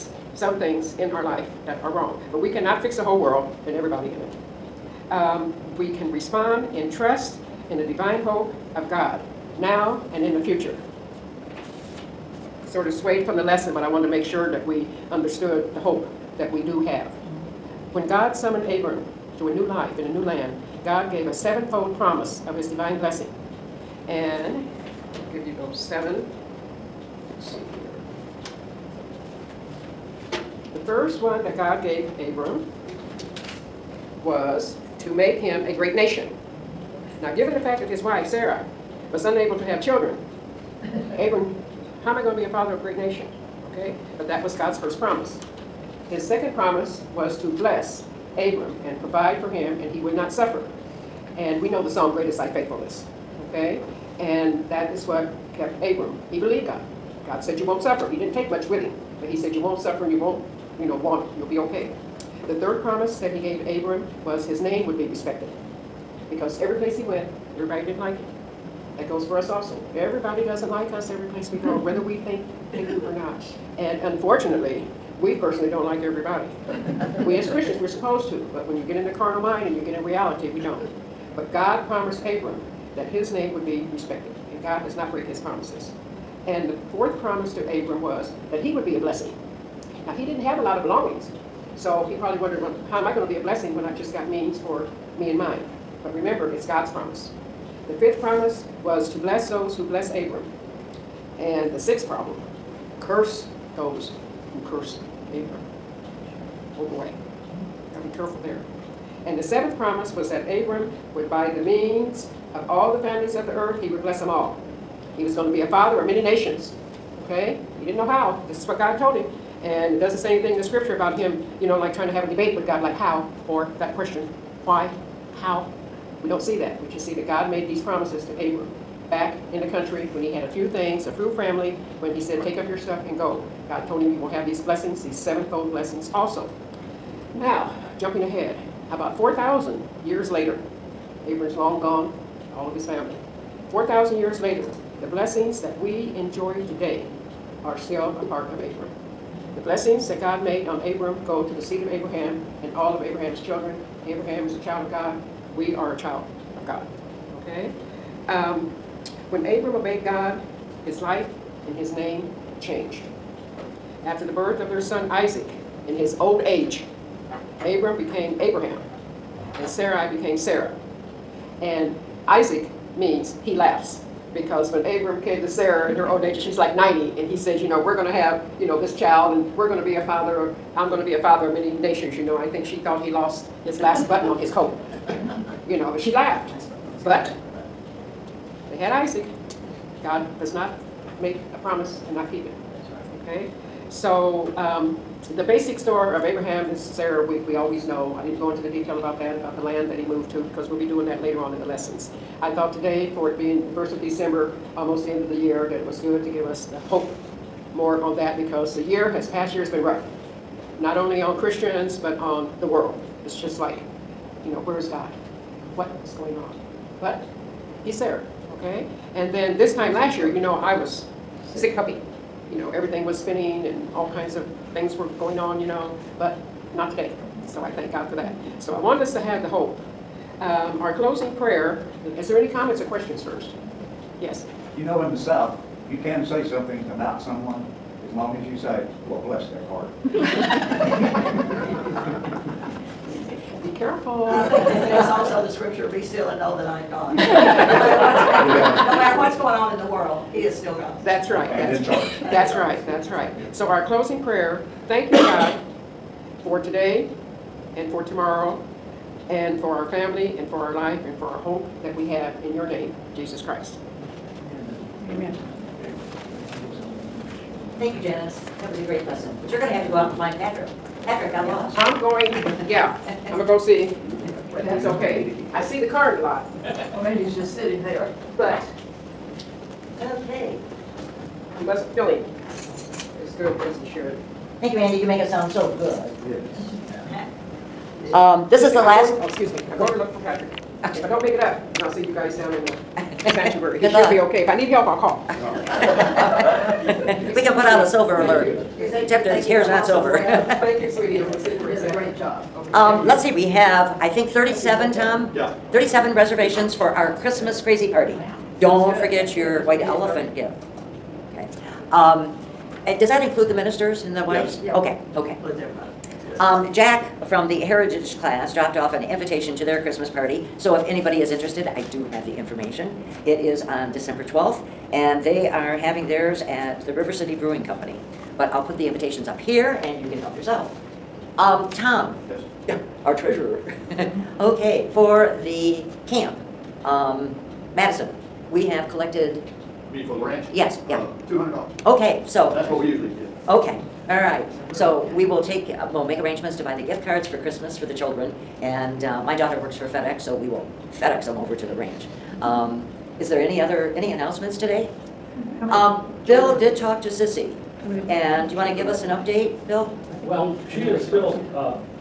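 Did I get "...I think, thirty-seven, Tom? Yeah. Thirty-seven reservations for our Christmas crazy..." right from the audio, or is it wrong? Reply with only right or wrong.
right.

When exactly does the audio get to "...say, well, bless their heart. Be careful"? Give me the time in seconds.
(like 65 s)
238 s.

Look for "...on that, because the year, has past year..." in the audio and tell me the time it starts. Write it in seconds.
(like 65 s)
208 s.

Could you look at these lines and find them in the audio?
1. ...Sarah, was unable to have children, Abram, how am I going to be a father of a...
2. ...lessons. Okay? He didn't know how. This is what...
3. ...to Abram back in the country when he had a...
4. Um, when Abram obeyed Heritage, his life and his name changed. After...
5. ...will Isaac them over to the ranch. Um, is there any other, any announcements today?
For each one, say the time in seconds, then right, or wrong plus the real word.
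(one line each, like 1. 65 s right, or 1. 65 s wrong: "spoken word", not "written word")
1. 38 s right
2. 116 s wrong: "nations", not "lessons"
3. 128 s right
4. 158 s wrong: "God", not "Heritage"
5. 350 s wrong: "FedEx", not "Isaac".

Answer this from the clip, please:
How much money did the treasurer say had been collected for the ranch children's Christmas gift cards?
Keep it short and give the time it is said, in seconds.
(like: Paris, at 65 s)
$200, at 341 s.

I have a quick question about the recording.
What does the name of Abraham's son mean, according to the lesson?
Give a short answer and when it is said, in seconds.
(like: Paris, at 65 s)
he laughs, at 173 s.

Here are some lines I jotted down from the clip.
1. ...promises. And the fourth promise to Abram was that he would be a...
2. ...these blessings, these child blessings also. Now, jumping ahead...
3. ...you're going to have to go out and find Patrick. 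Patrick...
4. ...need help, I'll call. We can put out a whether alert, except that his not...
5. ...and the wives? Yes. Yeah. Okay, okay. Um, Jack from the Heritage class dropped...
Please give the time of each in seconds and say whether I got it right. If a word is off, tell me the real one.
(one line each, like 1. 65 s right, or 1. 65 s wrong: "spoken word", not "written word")
1. 85 s right
2. 134 s wrong: "sevenfold", not "child"
3. 269 s right
4. 294 s wrong: "silver", not "whether"
5. 314 s right.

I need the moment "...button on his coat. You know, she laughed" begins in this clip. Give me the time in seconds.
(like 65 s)
184 s.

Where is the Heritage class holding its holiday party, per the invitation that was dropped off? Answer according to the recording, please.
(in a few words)
River City Brewing Company.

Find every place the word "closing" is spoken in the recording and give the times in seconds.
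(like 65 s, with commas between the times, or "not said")
230 s, 253 s.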